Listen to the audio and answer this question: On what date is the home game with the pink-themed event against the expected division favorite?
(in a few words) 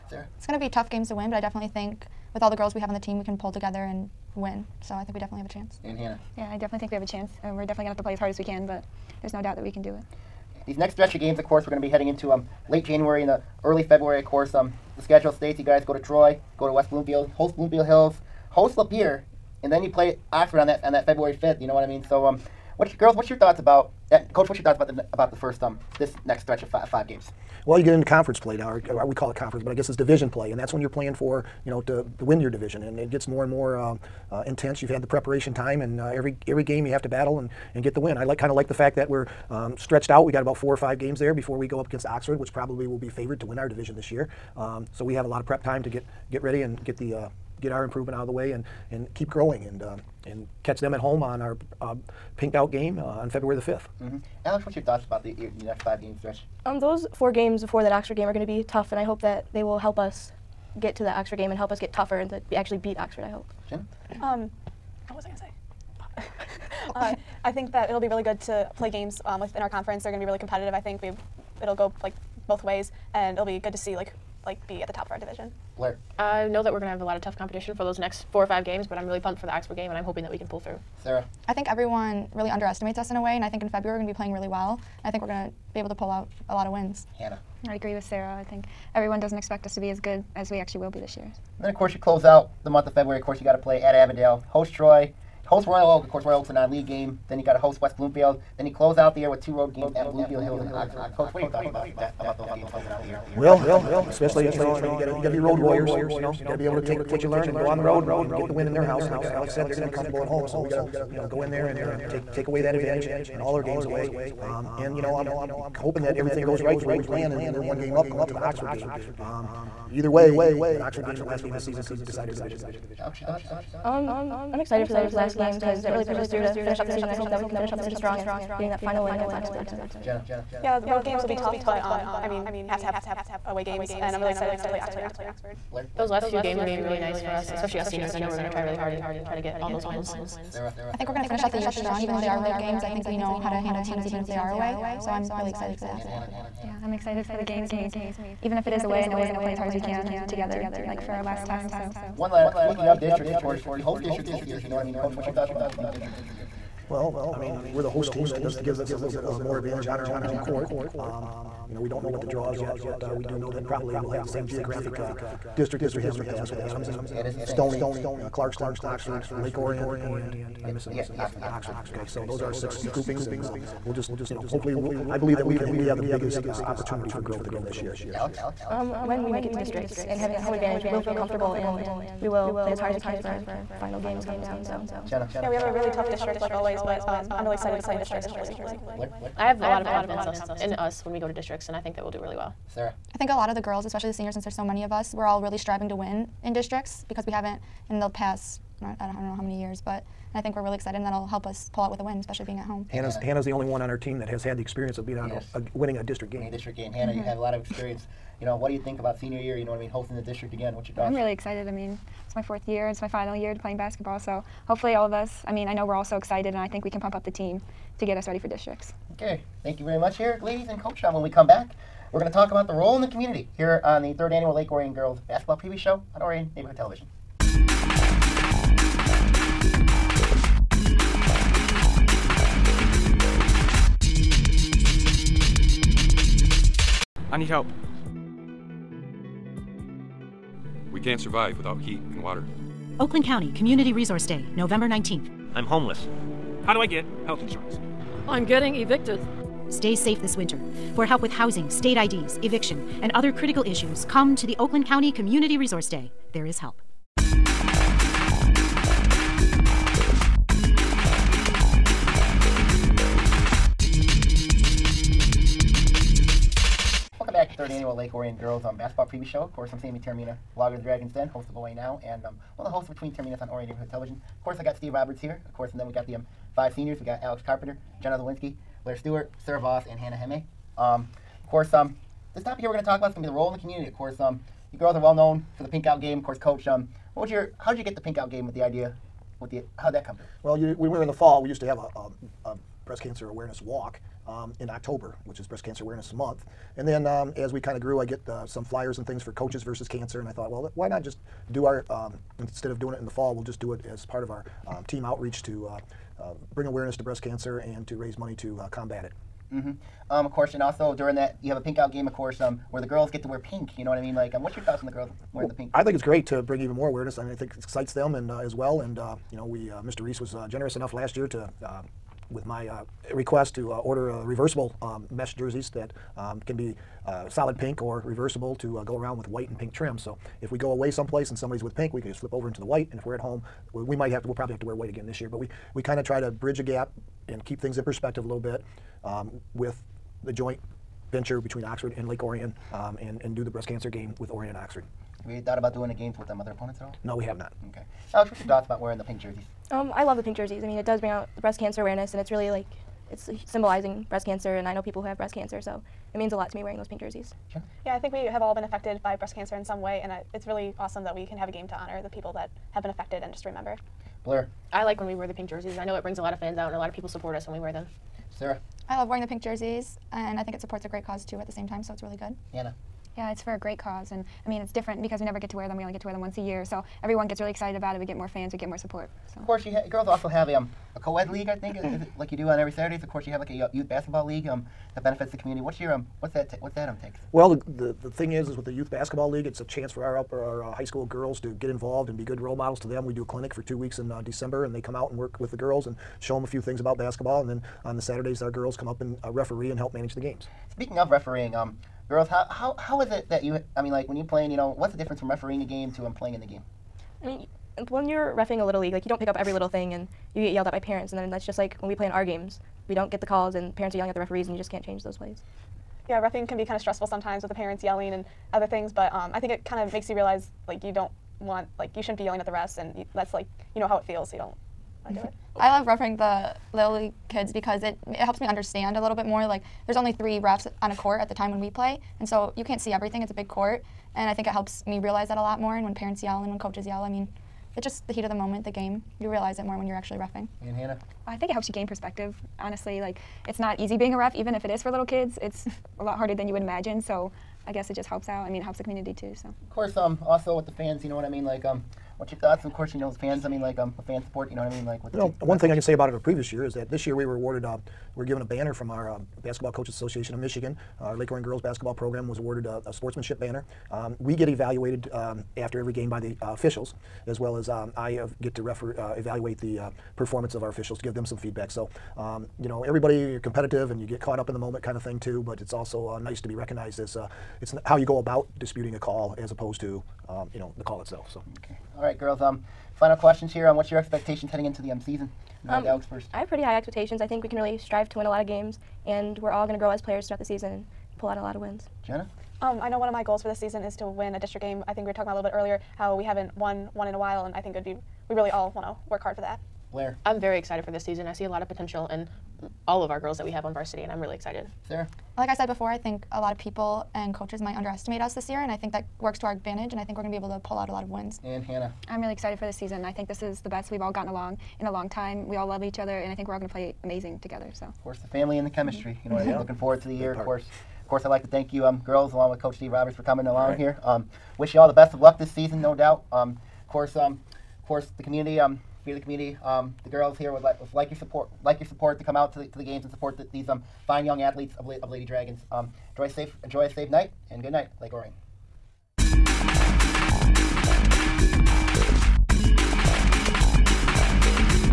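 February 5.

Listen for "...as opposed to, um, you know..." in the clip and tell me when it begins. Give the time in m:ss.
7:59.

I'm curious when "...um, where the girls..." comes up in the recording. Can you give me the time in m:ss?
5:12.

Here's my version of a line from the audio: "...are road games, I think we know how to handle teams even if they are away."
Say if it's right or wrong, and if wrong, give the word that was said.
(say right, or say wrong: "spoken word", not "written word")
right.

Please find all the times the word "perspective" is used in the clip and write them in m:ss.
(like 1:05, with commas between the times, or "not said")
5:37, 7:21.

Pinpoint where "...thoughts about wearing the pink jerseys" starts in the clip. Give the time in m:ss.
5:48.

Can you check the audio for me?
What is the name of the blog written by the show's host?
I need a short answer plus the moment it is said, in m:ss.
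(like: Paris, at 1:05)
Dragons Den, at 4:30.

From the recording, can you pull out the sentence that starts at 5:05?
Uh, uh, bring awareness to breast cancer and to raise money to uh, combat it.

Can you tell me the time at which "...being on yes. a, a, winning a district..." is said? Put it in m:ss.
3:25.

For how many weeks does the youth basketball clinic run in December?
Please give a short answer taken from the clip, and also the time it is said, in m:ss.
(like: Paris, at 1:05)
2, at 6:33.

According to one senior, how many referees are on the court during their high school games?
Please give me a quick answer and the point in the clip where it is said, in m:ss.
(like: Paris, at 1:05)
3, at 7:10.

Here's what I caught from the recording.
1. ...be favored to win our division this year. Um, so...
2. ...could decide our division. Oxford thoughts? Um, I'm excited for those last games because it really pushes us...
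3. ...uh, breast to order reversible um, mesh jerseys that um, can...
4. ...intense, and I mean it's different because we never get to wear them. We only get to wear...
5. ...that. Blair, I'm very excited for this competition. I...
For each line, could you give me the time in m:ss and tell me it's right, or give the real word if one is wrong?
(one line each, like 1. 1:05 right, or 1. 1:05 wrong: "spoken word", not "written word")
1. 0:42 right
2. 2:01 right
3. 5:22 wrong: "request", not "breast"
4. 6:13 wrong: "cause", not "intense"
5. 8:19 wrong: "season", not "competition".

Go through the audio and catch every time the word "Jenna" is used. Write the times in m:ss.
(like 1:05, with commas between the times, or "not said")
2:10, 3:05, 4:38, 8:12.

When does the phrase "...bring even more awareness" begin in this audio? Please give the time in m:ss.
5:16.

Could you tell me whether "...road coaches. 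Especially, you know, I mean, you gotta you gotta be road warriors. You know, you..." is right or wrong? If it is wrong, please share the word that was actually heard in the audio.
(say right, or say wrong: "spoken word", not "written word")
wrong: "games", not "coaches".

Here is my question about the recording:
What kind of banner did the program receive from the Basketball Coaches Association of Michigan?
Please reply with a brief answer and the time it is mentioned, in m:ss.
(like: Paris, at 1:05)
sportsmanship banner, at 7:42.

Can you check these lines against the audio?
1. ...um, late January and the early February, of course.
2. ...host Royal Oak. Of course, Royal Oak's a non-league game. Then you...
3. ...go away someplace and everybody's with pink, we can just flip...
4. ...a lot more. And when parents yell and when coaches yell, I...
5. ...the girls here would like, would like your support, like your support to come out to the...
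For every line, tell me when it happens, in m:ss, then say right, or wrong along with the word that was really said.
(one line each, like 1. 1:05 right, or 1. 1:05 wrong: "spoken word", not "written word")
1. 0:12 right
2. 1:35 right
3. 5:30 wrong: "somebody", not "everybody"
4. 7:15 right
5. 8:50 right.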